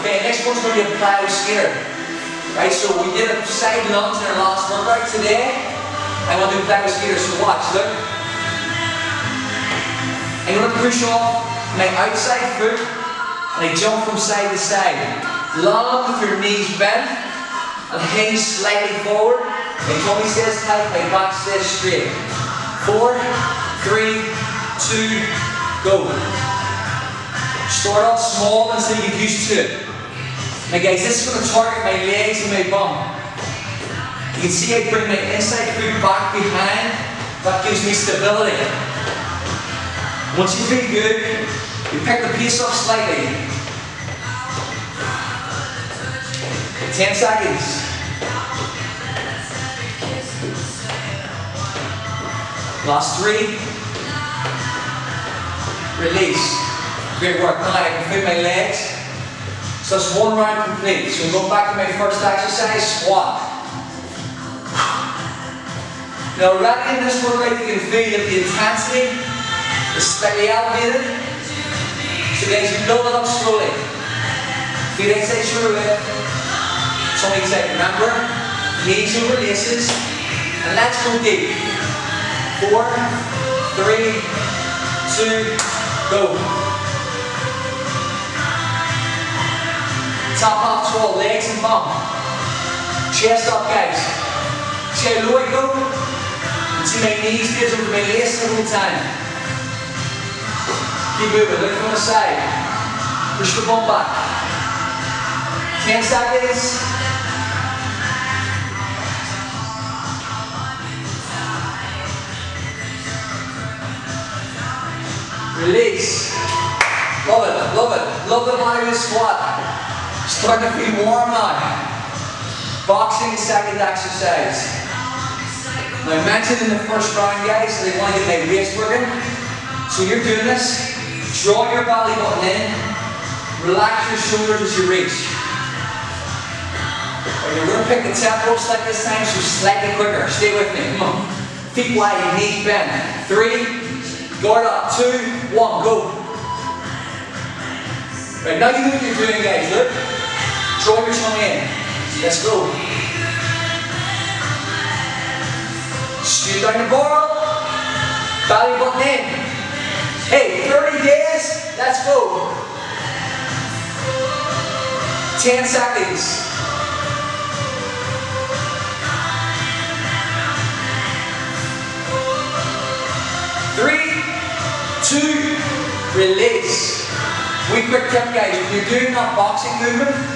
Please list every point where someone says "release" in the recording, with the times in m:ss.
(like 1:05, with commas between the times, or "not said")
0:56, 1:55, 2:56.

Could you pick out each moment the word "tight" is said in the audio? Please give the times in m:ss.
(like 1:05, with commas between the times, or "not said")
0:20.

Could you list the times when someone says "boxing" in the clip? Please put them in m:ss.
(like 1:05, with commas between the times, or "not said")
2:02, 2:59.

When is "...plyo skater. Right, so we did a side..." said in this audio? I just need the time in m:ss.
0:00.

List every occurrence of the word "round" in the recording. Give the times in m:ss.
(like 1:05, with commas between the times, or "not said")
1:00, 2:07.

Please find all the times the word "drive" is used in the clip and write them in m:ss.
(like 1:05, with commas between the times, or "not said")
not said.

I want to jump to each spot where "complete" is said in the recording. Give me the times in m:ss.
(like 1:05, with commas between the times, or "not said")
1:00.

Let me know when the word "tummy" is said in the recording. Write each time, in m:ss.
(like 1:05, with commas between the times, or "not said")
0:20.